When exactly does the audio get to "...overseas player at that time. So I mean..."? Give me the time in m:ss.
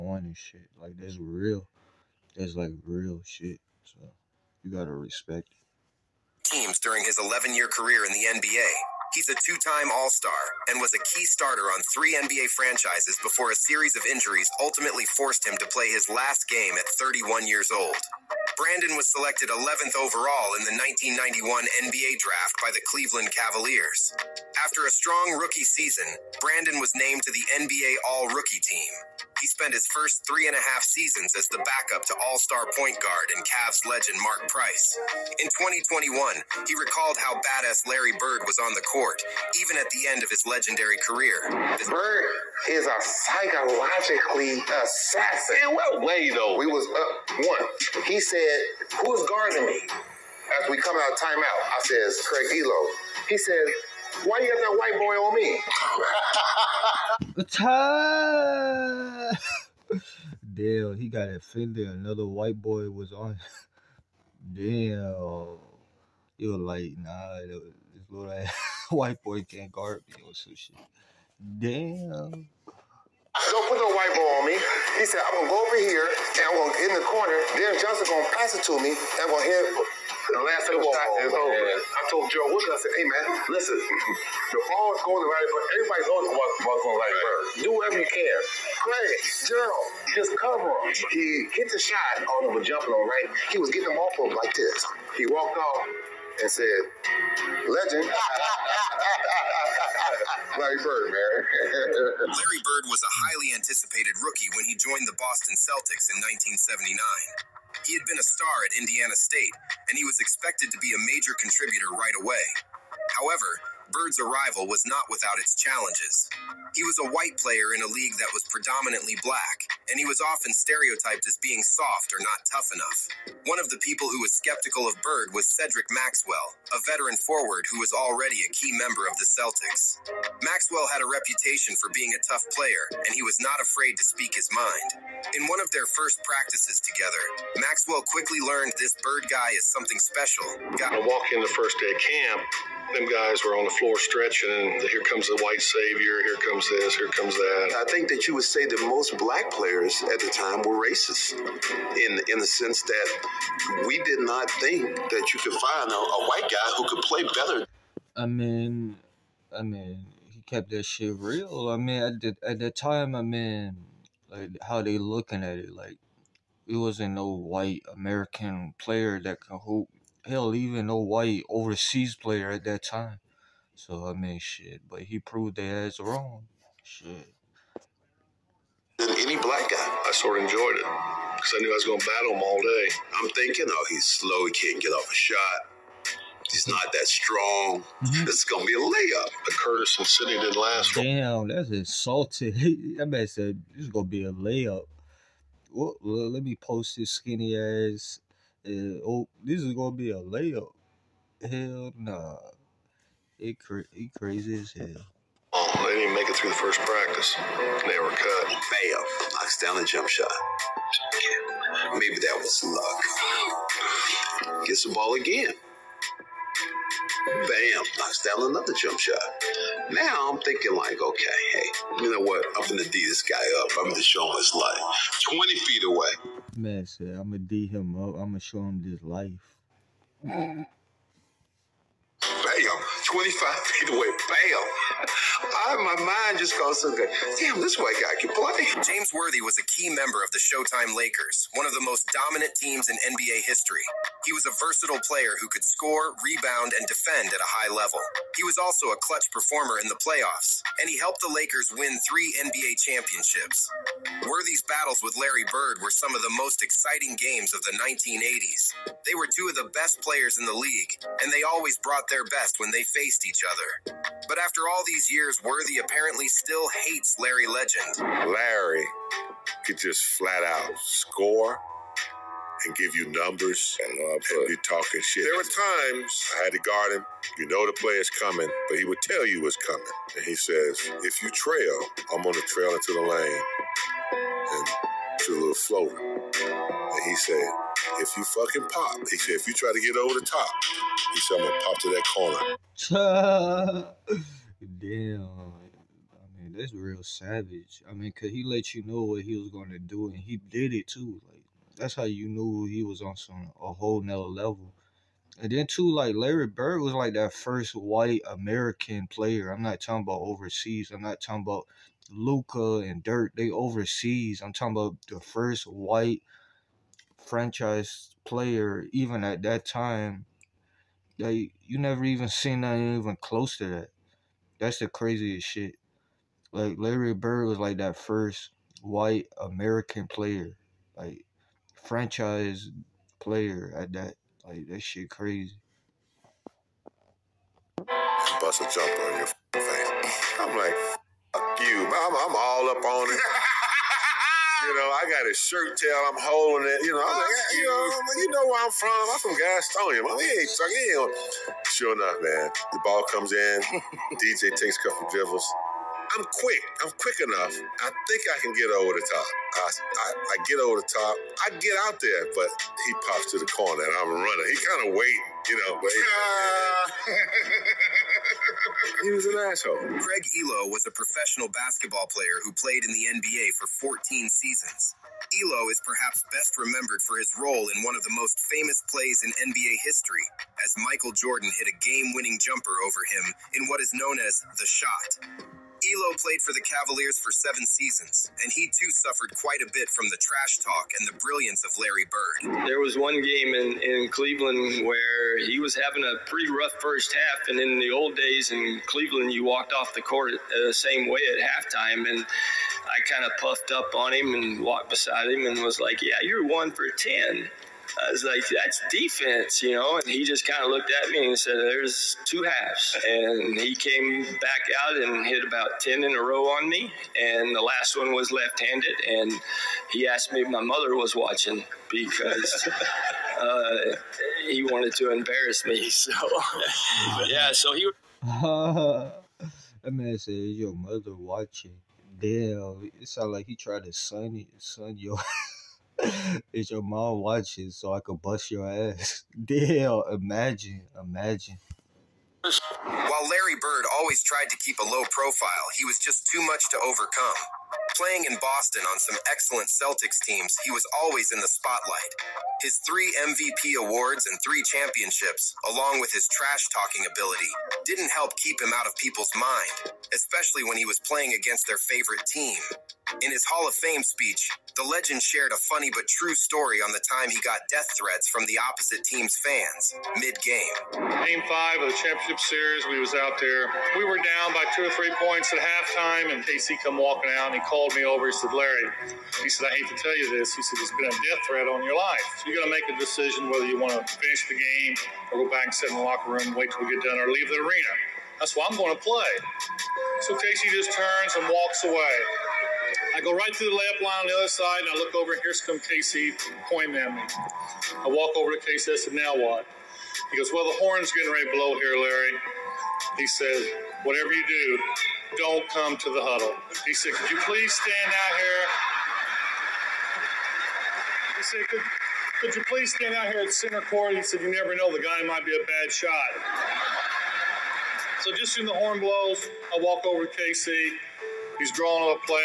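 2:51.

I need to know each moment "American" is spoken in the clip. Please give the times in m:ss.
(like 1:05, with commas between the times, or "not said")
2:47, 5:08, 5:29.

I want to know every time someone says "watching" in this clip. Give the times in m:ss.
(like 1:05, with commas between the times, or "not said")
7:01, 7:11, 7:17.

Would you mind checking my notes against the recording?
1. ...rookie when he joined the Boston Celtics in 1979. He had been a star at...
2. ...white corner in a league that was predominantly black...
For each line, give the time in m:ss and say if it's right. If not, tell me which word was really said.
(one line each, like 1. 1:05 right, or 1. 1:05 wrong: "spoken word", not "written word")
1. 1:44 right
2. 1:57 wrong: "player", not "corner".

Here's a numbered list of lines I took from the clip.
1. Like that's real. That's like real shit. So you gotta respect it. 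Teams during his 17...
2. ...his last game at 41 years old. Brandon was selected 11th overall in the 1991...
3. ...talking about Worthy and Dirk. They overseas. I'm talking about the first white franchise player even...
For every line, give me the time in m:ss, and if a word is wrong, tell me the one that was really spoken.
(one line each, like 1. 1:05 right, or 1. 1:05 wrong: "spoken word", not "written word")
1. 0:00 wrong: "11", not "17"
2. 0:15 wrong: "31", not "41"
3. 5:11 wrong: "Luka", not "Worthy".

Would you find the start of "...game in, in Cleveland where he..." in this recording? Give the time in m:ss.
6:33.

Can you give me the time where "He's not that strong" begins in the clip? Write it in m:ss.
3:06.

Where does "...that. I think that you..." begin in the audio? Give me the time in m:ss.
2:27.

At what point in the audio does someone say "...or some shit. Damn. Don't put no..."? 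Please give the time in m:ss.
1:10.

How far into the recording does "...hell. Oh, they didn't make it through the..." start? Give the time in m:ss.
3:24.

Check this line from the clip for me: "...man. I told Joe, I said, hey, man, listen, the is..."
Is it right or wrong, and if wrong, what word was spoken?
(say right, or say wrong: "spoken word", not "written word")
right.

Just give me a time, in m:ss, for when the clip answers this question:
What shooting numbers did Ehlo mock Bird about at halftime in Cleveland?
6:46.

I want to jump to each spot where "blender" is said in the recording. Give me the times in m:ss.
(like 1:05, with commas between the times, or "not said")
not said.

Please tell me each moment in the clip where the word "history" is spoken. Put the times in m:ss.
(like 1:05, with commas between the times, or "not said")
4:03, 6:19.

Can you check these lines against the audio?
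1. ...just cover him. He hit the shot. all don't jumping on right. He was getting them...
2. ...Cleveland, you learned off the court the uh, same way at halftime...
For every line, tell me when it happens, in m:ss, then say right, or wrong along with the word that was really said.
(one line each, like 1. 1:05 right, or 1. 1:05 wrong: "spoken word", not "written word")
1. 1:30 right
2. 6:38 wrong: "walked", not "learned".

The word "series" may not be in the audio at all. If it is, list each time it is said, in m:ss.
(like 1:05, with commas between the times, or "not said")
0:13, 7:52.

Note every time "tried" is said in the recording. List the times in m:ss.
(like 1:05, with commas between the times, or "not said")
7:13, 7:24.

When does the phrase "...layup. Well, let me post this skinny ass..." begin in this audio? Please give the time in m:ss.
3:14.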